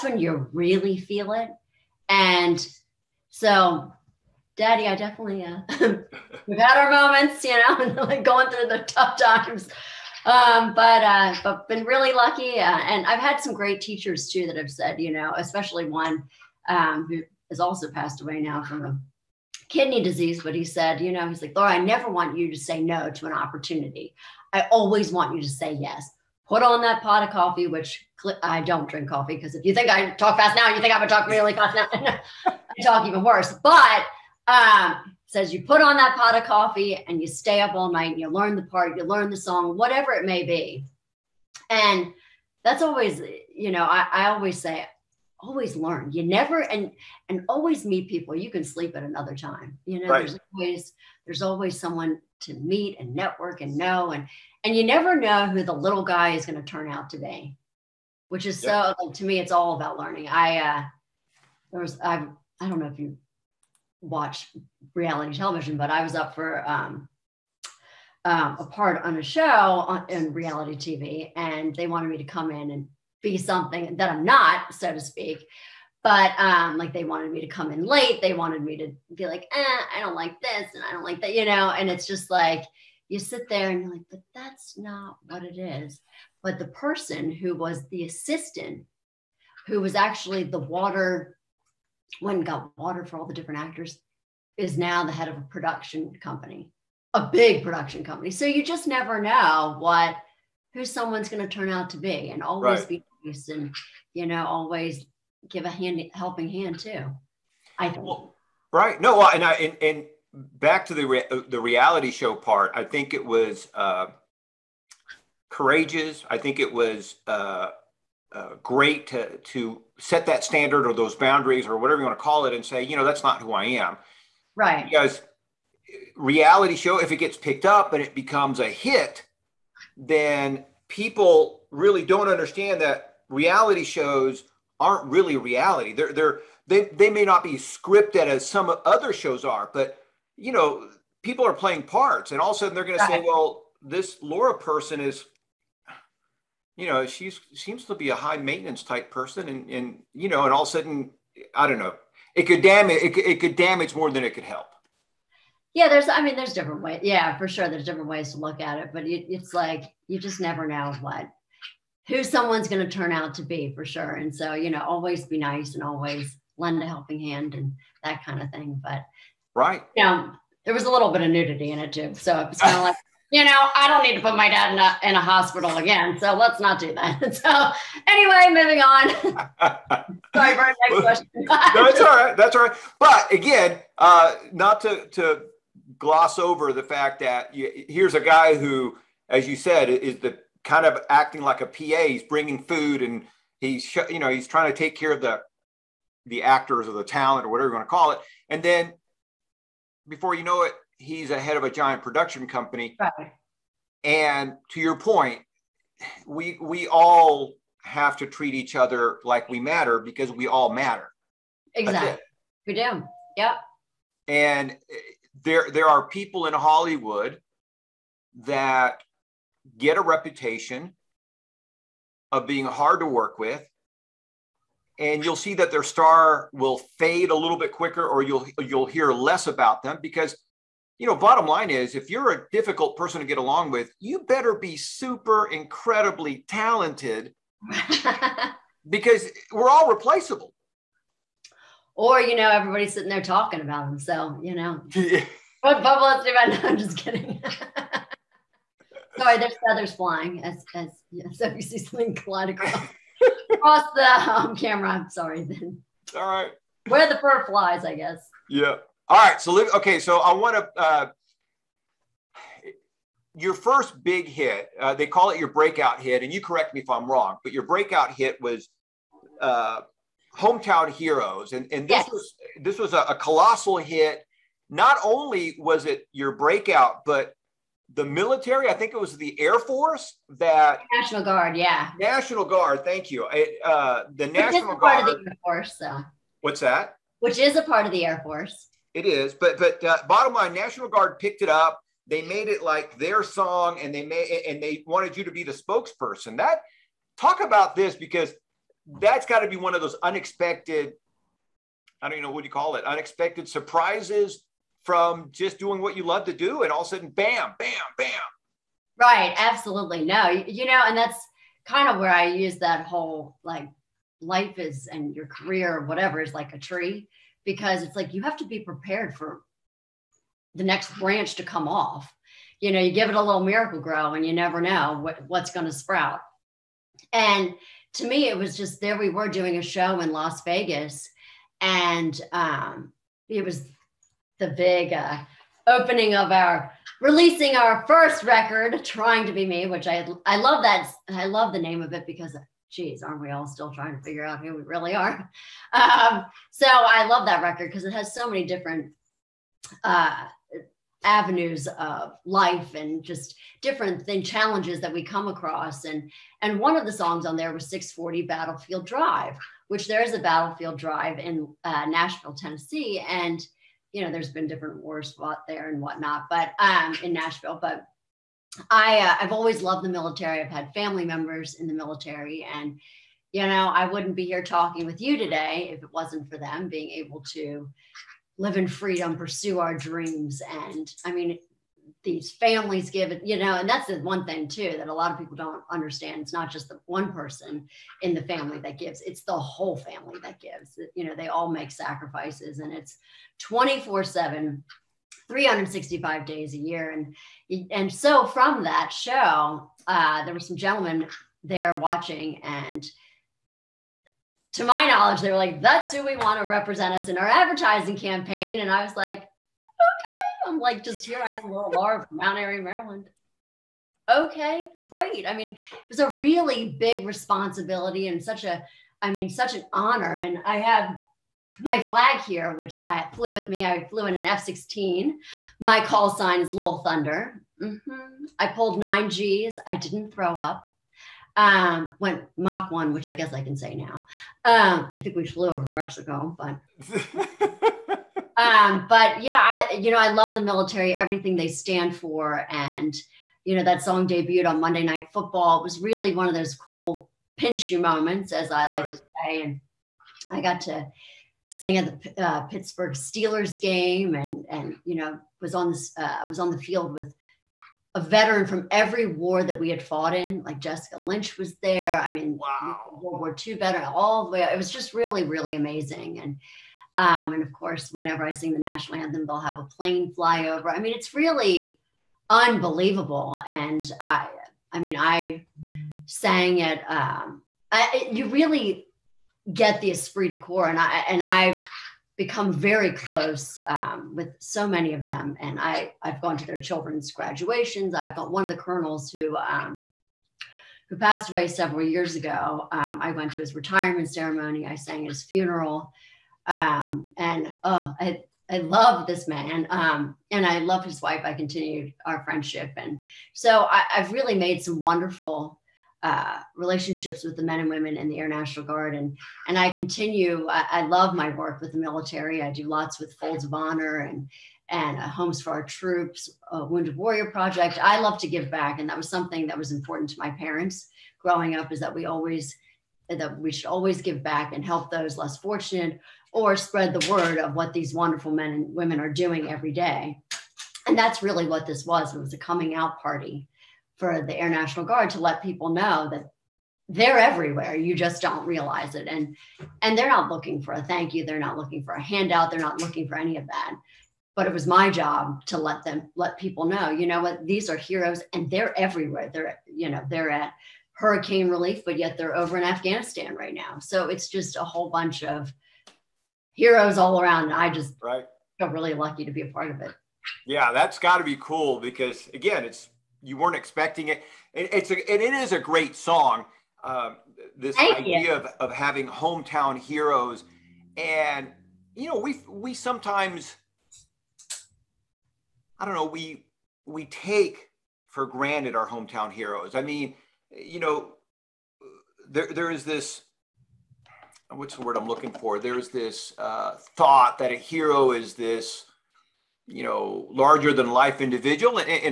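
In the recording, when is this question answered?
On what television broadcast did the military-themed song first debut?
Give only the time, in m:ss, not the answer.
7:24.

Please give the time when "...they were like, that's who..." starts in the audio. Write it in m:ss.
6:45.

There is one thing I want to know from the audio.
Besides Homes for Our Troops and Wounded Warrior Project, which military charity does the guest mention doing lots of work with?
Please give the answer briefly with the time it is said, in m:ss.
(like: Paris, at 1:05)
Folds of Honor, at 8:33.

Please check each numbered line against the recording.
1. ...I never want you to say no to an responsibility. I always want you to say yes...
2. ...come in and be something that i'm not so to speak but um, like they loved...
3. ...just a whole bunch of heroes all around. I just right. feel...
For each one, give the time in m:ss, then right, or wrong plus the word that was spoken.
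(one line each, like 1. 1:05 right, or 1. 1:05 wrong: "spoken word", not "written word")
1. 0:21 wrong: "opportunity", not "responsibility"
2. 1:12 wrong: "wanted", not "loved"
3. 9:14 right.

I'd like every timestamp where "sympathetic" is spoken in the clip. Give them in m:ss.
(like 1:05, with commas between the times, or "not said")
not said.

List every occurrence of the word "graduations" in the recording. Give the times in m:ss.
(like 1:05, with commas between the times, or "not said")
8:07.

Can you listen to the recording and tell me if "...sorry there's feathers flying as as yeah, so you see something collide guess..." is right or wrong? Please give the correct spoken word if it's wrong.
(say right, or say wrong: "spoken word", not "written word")
wrong: "across", not "guess".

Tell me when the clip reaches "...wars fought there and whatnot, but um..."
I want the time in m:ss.
6:04.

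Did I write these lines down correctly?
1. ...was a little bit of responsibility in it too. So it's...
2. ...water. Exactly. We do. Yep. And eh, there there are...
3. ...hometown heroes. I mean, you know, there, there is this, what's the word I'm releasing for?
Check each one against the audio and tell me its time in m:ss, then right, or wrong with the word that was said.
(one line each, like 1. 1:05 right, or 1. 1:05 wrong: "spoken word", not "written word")
1. 2:50 wrong: "nudity", not "responsibility"
2. 3:30 wrong: "matter", not "water"
3. 9:38 wrong: "looking", not "releasing".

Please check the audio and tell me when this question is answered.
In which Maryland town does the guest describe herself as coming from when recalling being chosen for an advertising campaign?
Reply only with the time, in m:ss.
6:52.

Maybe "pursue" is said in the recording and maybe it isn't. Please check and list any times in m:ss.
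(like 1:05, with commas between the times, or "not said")
6:19.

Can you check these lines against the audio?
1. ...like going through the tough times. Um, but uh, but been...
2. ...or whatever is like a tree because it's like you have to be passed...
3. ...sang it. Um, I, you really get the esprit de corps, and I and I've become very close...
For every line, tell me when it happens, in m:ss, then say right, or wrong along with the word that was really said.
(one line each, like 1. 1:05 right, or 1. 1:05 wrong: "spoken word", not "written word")
1. 0:08 right
2. 5:15 wrong: "prepared", not "passed"
3. 7:56 right.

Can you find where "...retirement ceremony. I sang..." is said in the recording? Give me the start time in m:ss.
8:13.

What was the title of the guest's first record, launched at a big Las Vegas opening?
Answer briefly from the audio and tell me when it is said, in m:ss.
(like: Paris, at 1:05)
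Trying to Be Me, at 5:38.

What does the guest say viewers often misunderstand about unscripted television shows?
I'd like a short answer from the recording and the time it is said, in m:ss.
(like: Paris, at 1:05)
aren't really reality, at 2:13.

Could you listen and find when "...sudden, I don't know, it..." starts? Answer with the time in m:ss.
2:30.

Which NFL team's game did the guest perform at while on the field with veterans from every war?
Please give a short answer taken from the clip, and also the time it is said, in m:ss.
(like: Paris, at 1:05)
Pittsburgh Steelers, at 7:32.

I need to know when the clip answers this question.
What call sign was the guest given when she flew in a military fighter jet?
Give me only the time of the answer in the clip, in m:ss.
7:06.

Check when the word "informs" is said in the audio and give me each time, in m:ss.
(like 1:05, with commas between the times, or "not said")
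not said.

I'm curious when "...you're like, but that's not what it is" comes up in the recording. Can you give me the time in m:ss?
1:23.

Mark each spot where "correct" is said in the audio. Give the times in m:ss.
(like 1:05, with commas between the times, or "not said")
4:26.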